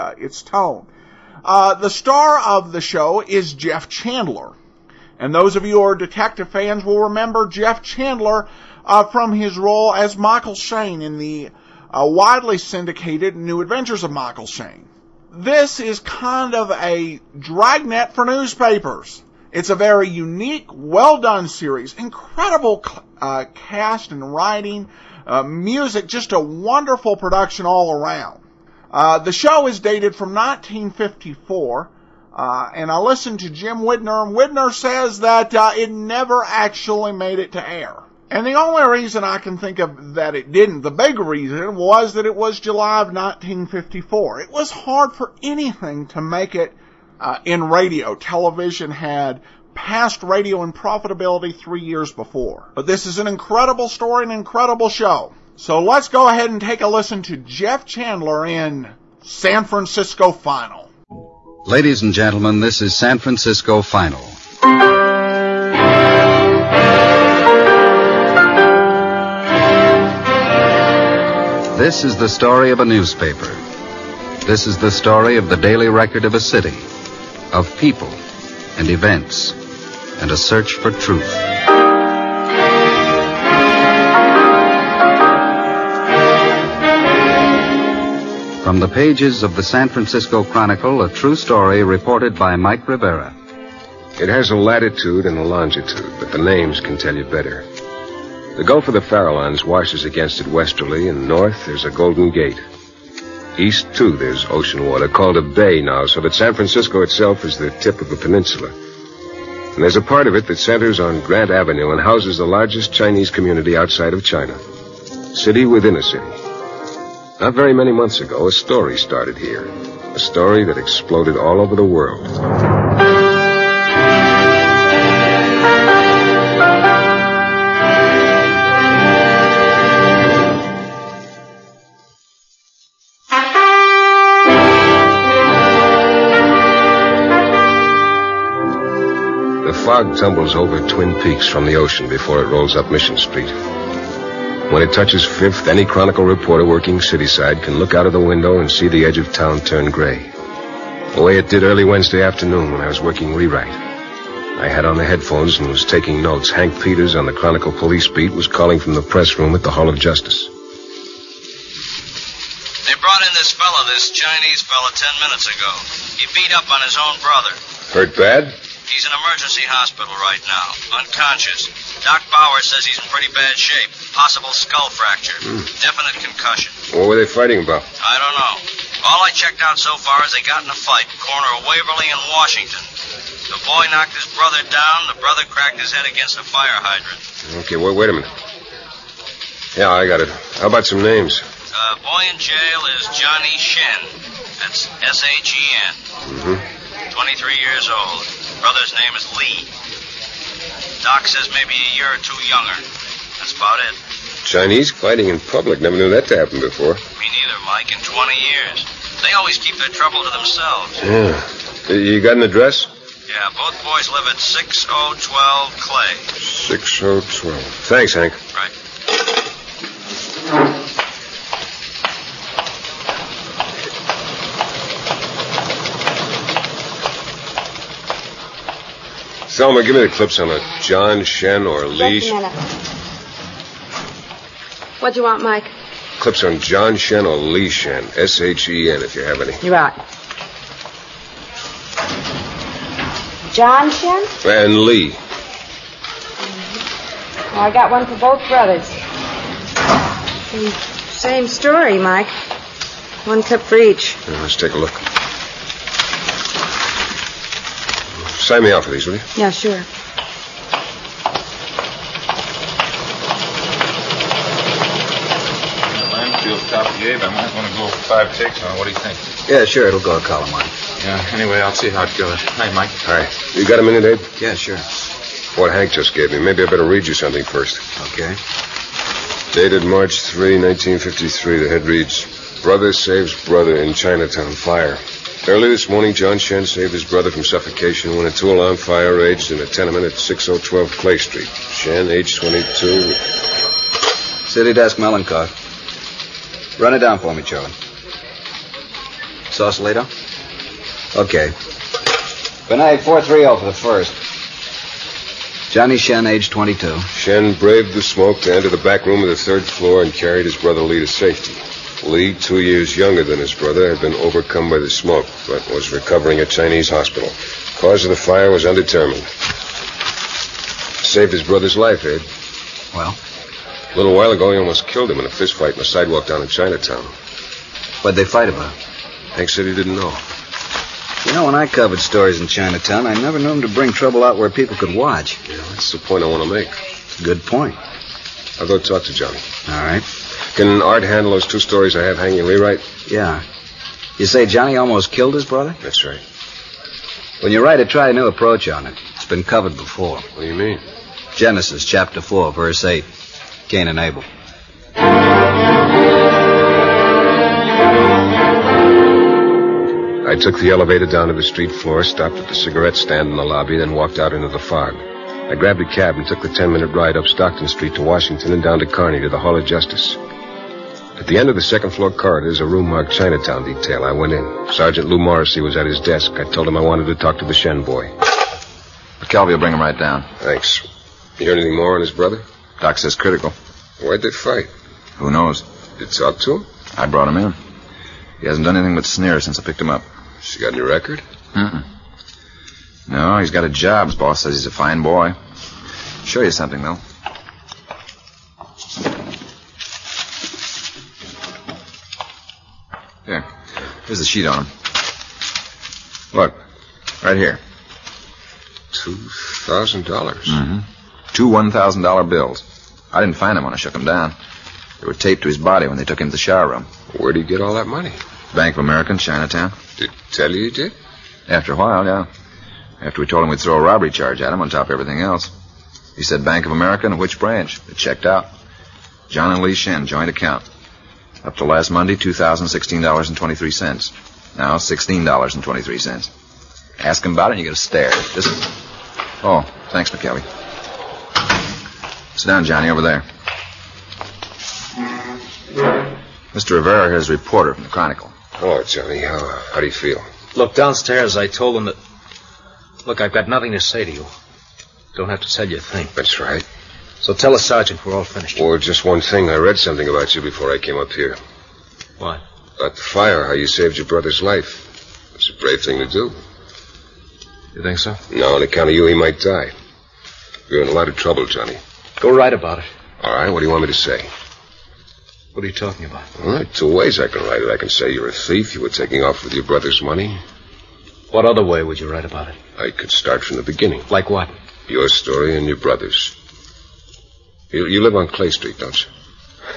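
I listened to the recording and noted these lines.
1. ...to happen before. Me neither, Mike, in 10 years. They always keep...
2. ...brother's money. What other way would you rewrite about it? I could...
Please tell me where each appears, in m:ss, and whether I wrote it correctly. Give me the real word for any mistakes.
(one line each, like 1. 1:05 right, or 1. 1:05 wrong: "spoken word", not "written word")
1. 3:26 wrong: "20", not "10"
2. 7:59 wrong: "write", not "rewrite".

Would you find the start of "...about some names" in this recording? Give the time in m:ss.
3:10.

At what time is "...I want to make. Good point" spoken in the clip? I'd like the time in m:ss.
5:36.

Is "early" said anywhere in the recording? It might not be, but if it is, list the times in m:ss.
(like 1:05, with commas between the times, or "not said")
2:31, 4:45.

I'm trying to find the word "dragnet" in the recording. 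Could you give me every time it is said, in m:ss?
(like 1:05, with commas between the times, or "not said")
0:17.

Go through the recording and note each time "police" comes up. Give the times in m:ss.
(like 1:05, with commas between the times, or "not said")
2:37.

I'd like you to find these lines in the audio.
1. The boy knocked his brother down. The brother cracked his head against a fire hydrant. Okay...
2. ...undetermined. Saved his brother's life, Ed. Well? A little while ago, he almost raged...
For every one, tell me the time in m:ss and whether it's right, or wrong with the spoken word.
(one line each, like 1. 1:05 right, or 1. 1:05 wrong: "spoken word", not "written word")
1. 3:03 right
2. 5:18 wrong: "killed", not "raged".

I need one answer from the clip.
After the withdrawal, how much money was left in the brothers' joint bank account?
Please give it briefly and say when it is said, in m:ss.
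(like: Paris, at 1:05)
$16.23, at 7:14.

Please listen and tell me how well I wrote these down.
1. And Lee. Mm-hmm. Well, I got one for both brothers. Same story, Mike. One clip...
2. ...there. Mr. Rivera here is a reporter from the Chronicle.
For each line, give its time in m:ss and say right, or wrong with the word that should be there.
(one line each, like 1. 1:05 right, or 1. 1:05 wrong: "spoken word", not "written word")
1. 4:04 right
2. 7:23 right.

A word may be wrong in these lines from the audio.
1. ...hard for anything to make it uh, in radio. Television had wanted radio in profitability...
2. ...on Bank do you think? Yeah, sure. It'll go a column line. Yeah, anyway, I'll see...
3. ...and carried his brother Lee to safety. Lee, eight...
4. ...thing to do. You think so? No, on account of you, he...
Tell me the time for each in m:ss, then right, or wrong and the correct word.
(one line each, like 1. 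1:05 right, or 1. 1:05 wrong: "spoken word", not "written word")
1. 0:44 wrong: "passed", not "wanted"
2. 4:28 wrong: "What", not "Bank"
3. 5:10 wrong: "two", not "eight"
4. 7:45 right.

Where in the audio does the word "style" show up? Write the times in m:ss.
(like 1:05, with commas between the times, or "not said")
not said.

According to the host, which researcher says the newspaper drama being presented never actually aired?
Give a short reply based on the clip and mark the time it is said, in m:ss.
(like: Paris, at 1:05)
Jim Widner, at 0:33.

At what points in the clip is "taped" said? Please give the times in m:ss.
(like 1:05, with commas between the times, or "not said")
6:55.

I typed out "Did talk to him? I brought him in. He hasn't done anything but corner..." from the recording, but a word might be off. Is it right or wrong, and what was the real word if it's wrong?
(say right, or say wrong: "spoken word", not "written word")
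wrong: "sneer", not "corner".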